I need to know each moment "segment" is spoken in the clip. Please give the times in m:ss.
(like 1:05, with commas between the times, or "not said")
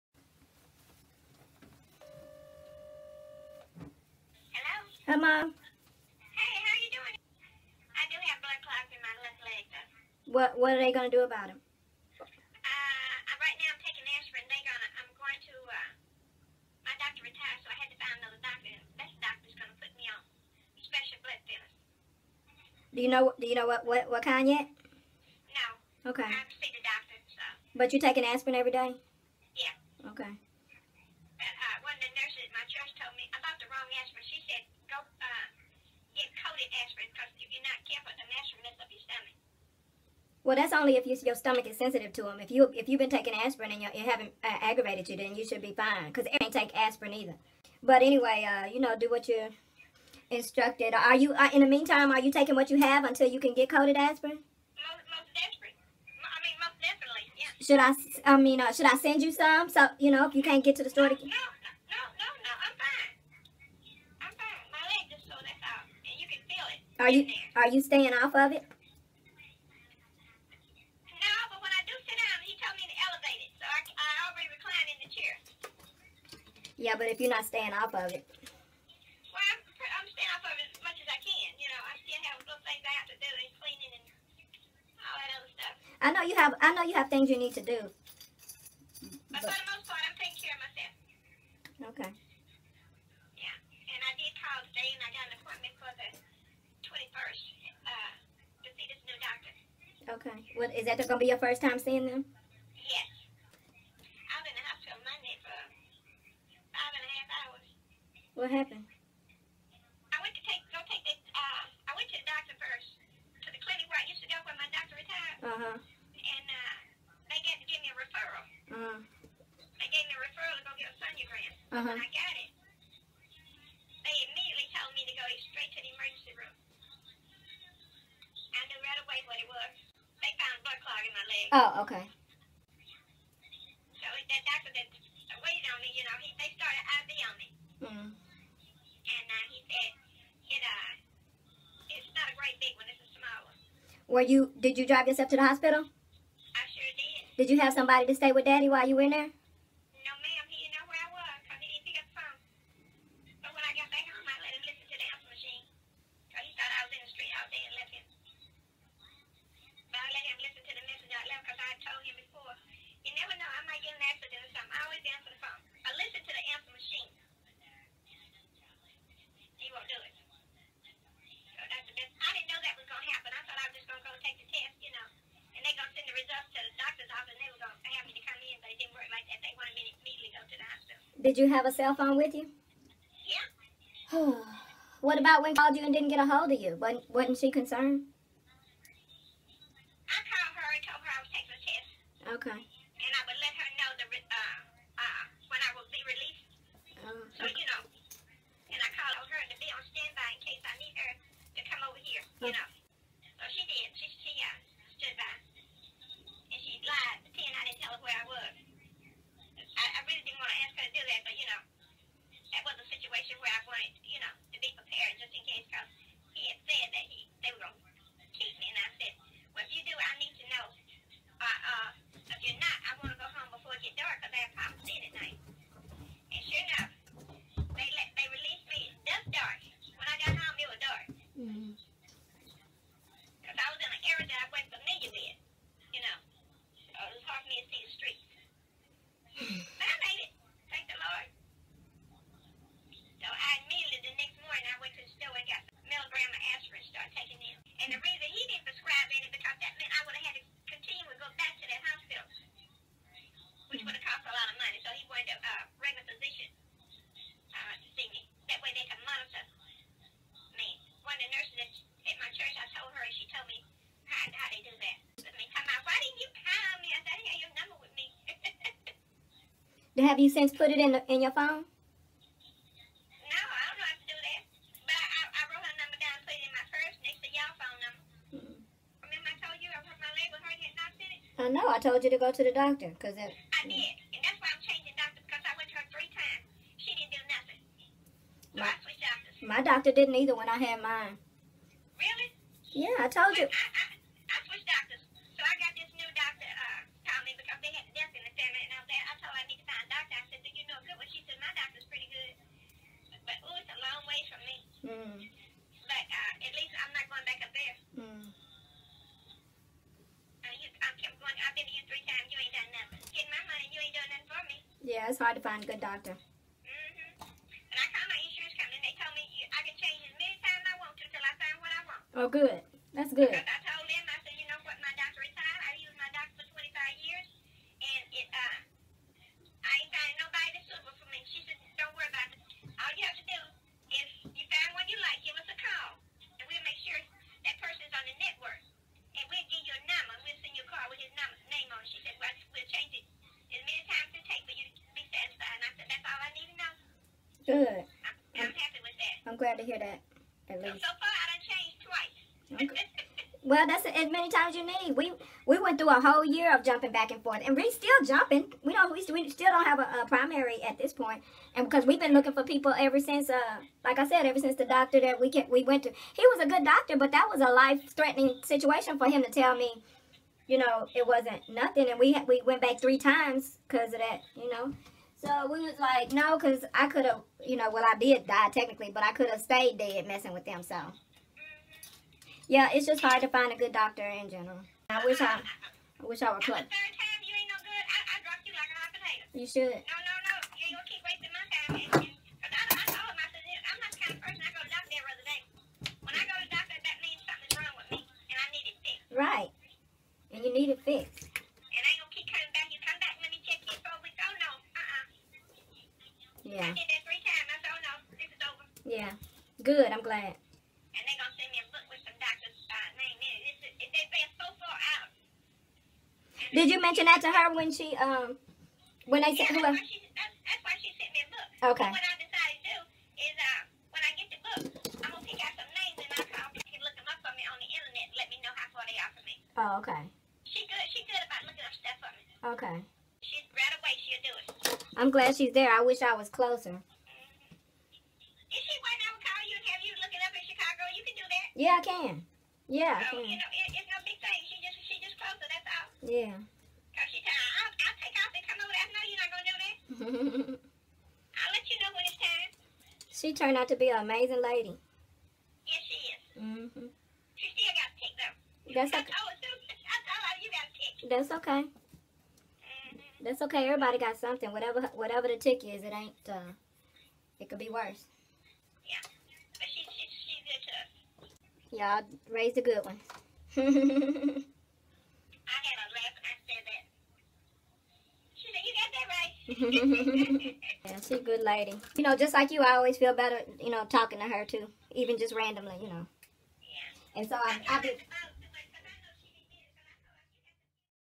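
not said.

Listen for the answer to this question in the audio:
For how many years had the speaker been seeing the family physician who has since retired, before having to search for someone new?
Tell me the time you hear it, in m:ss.
5:26.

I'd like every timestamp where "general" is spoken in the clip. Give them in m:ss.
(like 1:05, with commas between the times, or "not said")
6:24.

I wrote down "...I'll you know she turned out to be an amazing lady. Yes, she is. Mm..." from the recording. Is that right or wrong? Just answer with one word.
right.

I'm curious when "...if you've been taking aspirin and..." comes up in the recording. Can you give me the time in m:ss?
0:42.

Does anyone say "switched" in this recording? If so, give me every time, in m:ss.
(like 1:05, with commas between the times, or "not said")
4:48, 4:54.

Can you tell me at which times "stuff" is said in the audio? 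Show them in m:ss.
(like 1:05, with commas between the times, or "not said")
1:25, 7:11.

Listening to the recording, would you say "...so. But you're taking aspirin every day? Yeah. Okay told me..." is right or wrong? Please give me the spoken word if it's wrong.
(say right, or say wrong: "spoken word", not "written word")
right.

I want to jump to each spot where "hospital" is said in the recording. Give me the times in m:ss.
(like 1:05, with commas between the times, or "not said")
1:44, 2:25, 3:00.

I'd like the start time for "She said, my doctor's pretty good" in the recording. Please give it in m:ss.
5:01.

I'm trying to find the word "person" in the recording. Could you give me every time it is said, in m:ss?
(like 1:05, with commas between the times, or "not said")
5:37, 6:34.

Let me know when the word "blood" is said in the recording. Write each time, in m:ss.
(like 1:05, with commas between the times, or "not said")
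0:08, 0:21.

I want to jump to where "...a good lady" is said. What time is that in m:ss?
8:01.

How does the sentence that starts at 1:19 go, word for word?
Well, I'm, I'm staying off of it as much as I can.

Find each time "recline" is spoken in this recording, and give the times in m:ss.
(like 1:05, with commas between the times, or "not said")
1:14.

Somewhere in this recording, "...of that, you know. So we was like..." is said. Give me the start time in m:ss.
6:13.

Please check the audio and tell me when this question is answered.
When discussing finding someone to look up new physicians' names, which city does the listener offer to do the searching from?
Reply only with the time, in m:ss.
7:20.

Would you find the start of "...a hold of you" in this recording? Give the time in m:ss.
3:06.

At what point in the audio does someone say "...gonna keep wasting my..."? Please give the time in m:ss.
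6:29.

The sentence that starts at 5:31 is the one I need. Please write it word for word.
She said, don't worry about it.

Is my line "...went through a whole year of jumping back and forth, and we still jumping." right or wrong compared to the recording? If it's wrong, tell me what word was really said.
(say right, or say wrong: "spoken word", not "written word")
right.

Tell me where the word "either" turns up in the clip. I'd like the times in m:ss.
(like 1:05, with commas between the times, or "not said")
0:47, 4:50.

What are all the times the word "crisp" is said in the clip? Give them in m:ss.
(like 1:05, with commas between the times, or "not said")
not said.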